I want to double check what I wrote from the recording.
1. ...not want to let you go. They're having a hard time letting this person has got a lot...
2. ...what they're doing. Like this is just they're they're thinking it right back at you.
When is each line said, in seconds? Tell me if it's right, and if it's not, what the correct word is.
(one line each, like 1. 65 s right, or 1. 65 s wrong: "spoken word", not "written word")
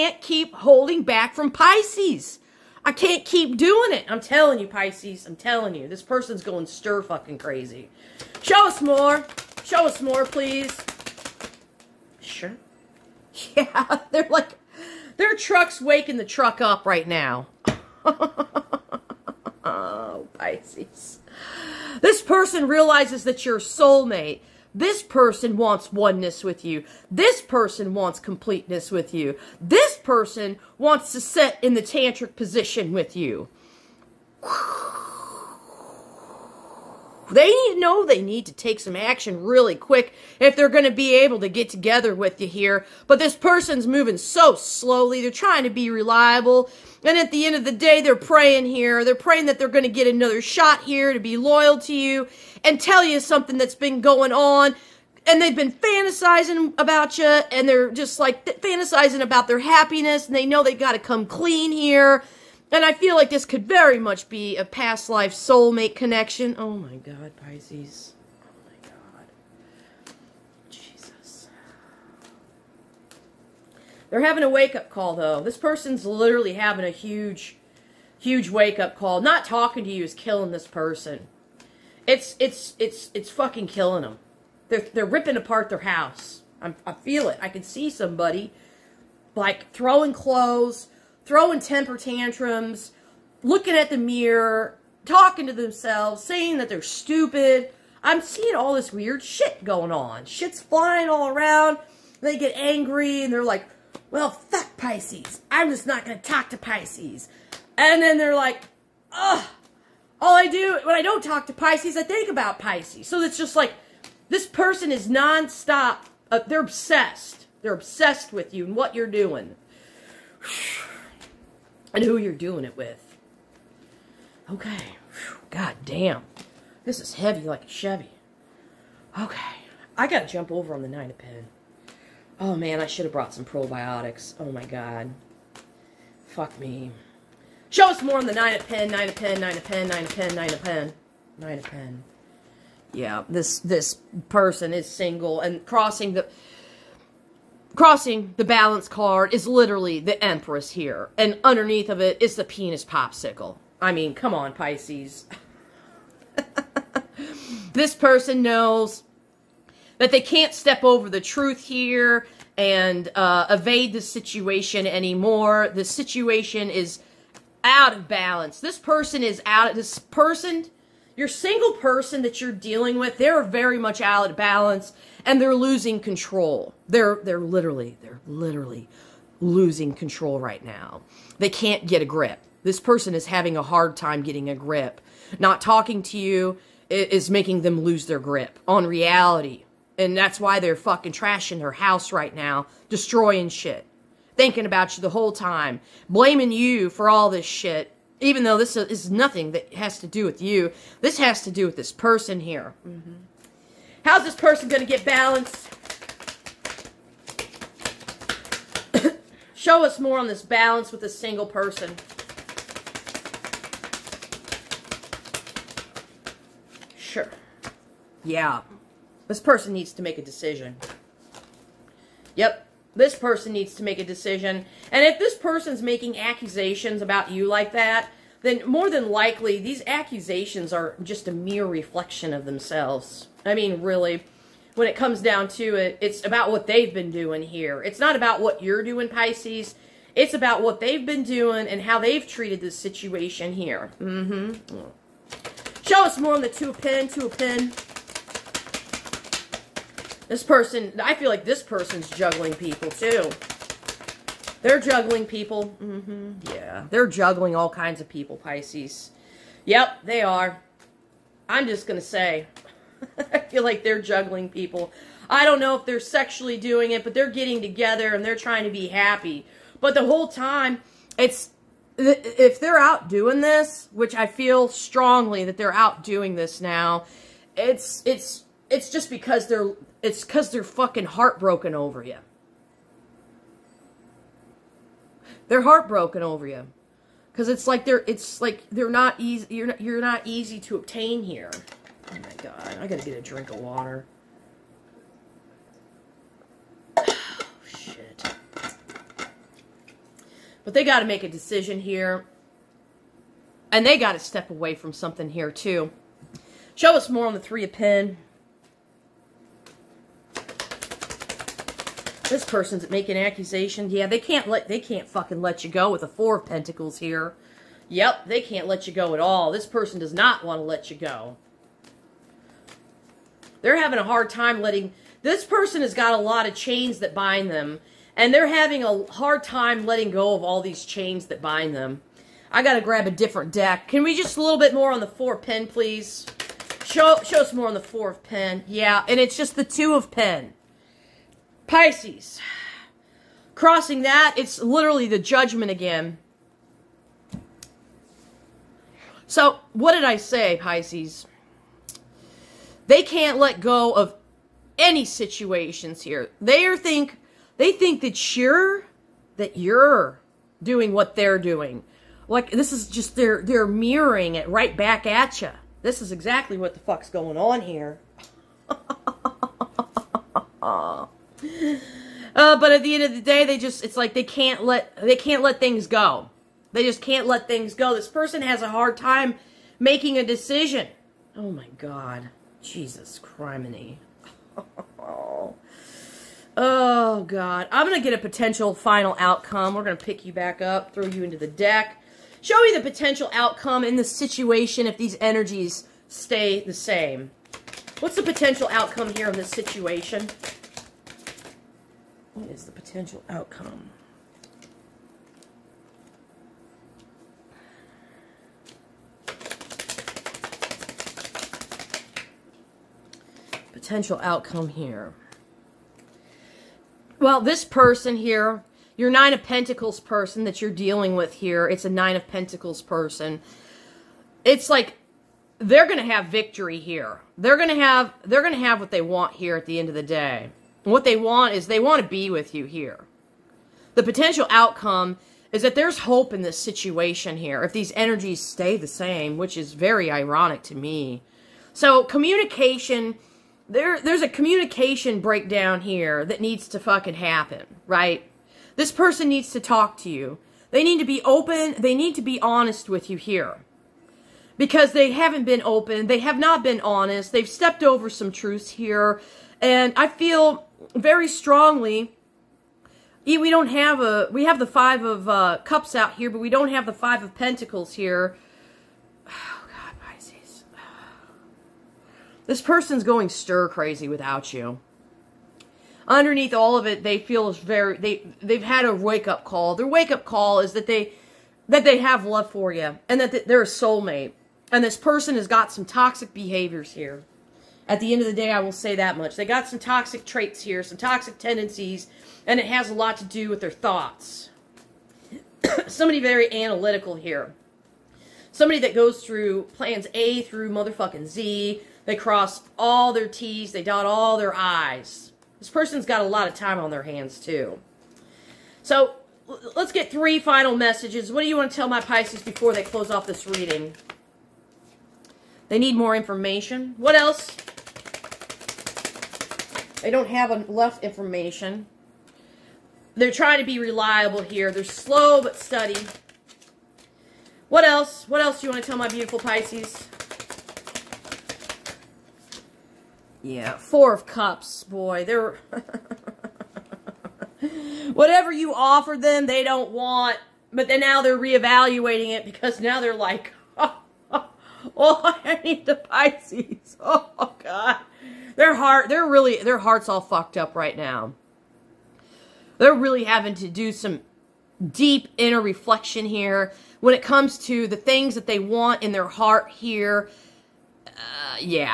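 1. 320 s right
2. 360 s wrong: "mirroring", not "thinking".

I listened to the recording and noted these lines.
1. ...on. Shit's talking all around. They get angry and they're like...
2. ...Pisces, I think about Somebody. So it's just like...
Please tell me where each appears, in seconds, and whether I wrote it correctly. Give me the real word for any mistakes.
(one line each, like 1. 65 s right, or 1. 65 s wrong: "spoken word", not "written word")
1. 99 s wrong: "flying", not "talking"
2. 111 s wrong: "Pisces", not "Somebody".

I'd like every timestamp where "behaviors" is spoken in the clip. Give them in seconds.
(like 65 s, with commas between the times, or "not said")
486 s.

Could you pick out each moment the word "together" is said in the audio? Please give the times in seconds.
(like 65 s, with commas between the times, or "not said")
41 s, 267 s.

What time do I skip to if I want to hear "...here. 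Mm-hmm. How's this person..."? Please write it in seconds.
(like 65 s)
202 s.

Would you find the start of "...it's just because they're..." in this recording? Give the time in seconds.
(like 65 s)
278 s.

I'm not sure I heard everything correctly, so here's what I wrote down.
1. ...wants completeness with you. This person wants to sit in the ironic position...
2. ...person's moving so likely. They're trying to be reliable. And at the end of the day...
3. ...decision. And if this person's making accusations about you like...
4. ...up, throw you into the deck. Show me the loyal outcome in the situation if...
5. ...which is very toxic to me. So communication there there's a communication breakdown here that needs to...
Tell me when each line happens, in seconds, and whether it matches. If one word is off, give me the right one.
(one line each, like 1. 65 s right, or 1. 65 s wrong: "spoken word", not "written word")
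1. 27 s wrong: "tantric", not "ironic"
2. 43 s wrong: "slowly", not "likely"
3. 224 s right
4. 390 s wrong: "potential", not "loyal"
5. 439 s wrong: "ironic", not "toxic".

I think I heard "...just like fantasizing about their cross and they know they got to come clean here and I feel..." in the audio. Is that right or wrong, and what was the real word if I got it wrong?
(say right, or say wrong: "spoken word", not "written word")
wrong: "happiness", not "cross".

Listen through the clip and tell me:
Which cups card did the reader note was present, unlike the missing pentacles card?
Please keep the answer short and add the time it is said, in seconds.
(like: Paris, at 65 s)
5 of Cups, at 464 s.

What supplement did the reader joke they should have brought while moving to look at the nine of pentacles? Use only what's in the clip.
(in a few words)
probiotics.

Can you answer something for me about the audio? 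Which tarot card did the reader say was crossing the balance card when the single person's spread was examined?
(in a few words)
The Empress.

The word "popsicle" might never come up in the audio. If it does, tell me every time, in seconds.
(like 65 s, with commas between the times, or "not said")
152 s.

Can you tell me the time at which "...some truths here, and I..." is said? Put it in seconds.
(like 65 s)
458 s.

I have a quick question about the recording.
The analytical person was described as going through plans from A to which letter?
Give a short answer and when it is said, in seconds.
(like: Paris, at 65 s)
Z, at 501 s.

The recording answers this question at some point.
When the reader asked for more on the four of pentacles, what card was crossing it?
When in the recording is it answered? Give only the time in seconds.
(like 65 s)
345 s.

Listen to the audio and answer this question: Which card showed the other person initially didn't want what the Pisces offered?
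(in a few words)
Four of Cups.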